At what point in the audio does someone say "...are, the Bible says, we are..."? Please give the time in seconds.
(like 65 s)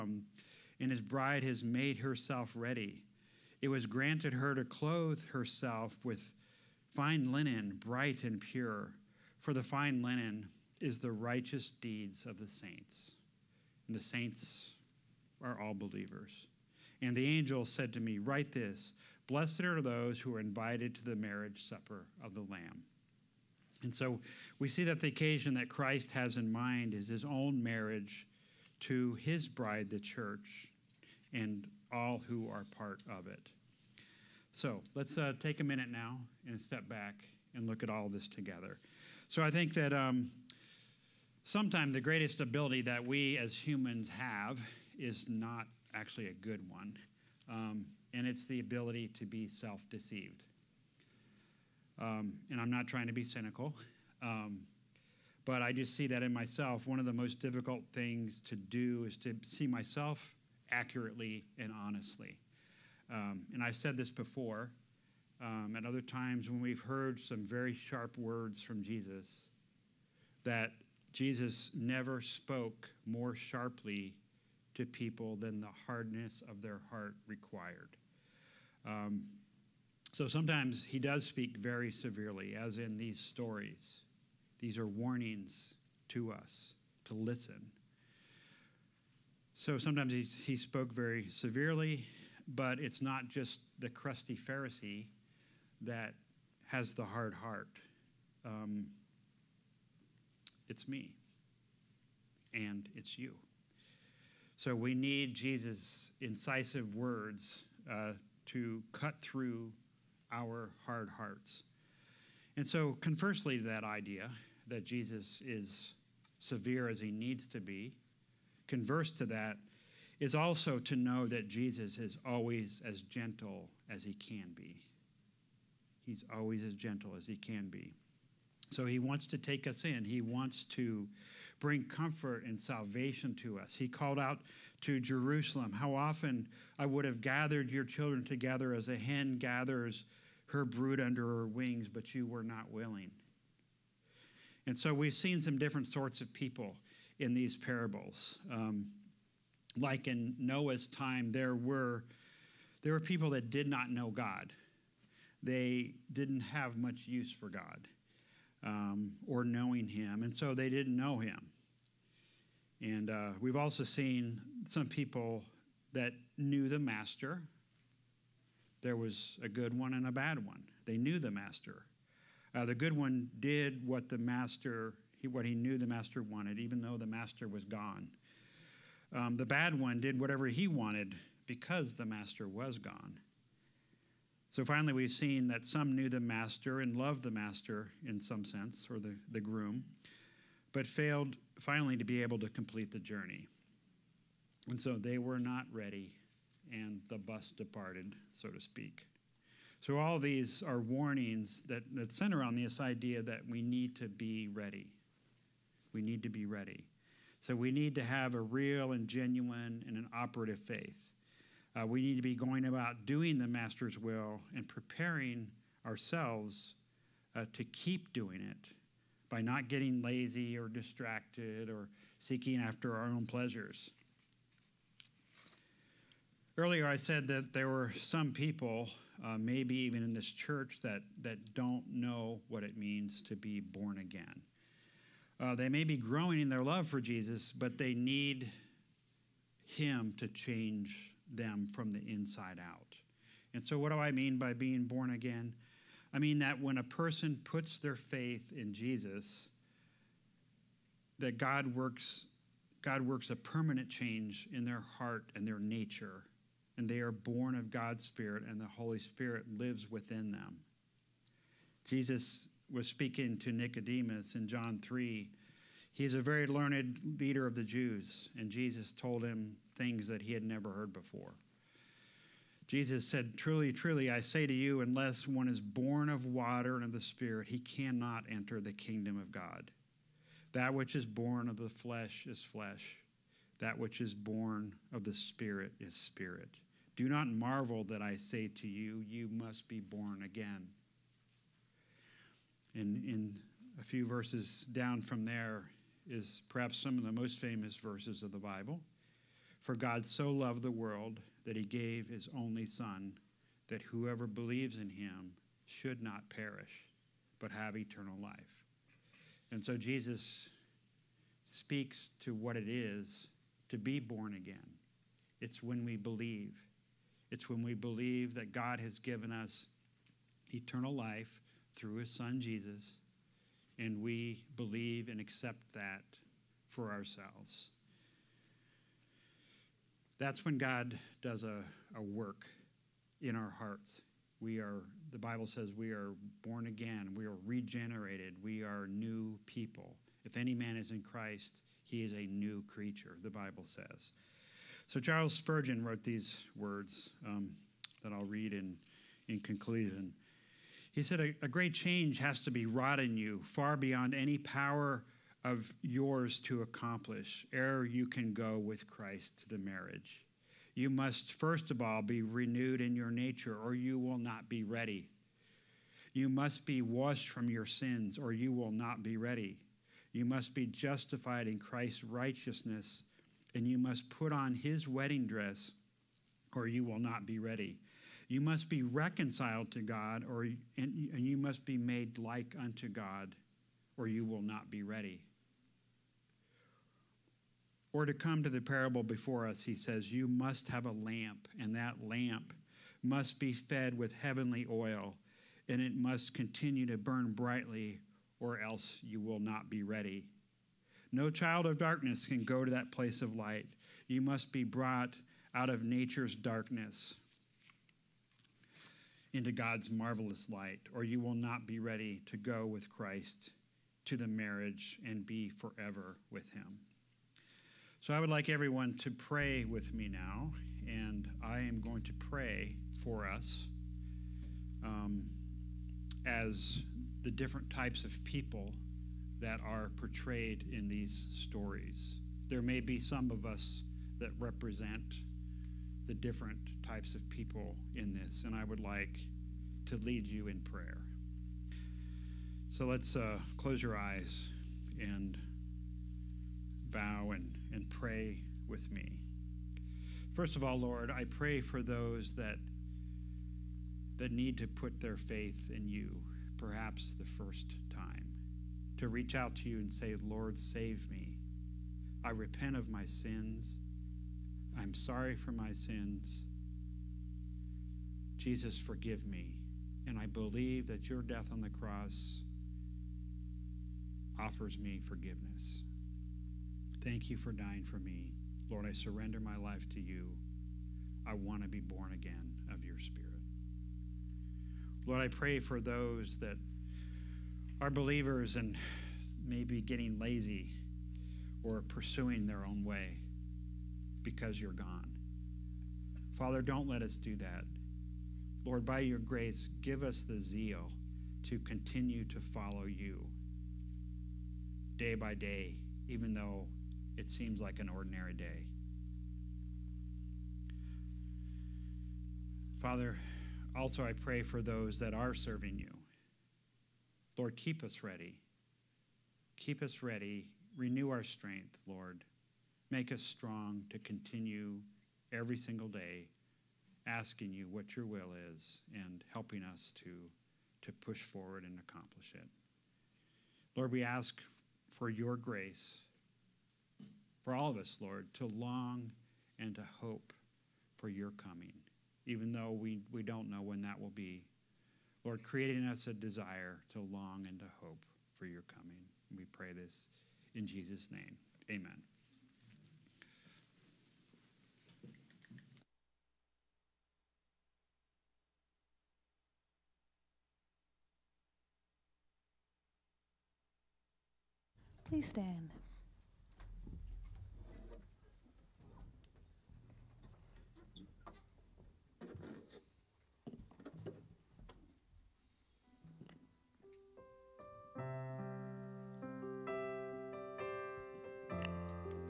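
334 s.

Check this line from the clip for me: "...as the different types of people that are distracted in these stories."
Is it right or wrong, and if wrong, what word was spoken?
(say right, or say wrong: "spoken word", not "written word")
wrong: "portrayed", not "distracted".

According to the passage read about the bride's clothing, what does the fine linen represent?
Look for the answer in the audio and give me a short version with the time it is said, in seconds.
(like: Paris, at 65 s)
The righteous deeds of the saints, at 10 s.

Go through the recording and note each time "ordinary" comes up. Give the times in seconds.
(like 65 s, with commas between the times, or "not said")
507 s.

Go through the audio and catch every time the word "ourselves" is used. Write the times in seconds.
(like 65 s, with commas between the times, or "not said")
215 s, 326 s.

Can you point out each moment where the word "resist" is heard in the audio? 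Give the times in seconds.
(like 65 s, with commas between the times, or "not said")
not said.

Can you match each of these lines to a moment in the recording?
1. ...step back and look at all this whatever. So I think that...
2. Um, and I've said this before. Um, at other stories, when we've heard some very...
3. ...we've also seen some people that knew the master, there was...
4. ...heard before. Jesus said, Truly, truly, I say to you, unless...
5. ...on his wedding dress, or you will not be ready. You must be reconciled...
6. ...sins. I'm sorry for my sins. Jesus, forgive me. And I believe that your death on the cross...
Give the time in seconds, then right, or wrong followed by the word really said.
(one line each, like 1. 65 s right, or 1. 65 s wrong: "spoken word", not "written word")
1. 36 s wrong: "together", not "whatever"
2. 63 s wrong: "times", not "stories"
3. 163 s right
4. 270 s right
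5. 374 s right
6. 463 s right.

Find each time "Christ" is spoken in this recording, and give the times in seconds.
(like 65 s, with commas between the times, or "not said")
25 s, 341 s, 358 s, 371 s, 412 s.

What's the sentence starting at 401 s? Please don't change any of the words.
No child of darkness can go to that place of light.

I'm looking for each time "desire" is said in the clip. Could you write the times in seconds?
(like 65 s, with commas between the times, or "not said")
546 s.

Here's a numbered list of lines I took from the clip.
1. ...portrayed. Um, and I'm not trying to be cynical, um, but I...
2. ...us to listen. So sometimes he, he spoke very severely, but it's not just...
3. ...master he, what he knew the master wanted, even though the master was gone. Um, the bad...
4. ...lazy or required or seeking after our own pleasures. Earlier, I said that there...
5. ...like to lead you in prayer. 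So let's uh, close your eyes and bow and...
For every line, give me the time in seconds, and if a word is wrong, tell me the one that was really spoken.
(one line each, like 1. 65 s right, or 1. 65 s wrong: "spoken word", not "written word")
1. 49 s wrong: "deceived", not "portrayed"
2. 86 s right
3. 174 s right
4. 220 s wrong: "distracted", not "required"
5. 438 s right.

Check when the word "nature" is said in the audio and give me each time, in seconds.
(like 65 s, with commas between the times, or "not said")
255 s, 363 s, 405 s.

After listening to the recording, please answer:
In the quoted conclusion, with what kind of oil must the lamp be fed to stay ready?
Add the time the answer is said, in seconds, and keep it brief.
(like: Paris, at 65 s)
Heavenly oil, at 394 s.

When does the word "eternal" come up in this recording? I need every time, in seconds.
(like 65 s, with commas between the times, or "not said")
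307 s, 320 s.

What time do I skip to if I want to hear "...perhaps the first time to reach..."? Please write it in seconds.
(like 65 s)
456 s.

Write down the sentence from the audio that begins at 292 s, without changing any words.
And in a few verses down from there is perhaps some of the most famous verses of the Bible.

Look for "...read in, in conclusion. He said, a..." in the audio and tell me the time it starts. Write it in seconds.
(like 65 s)
348 s.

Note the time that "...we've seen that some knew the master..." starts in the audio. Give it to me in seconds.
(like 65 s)
184 s.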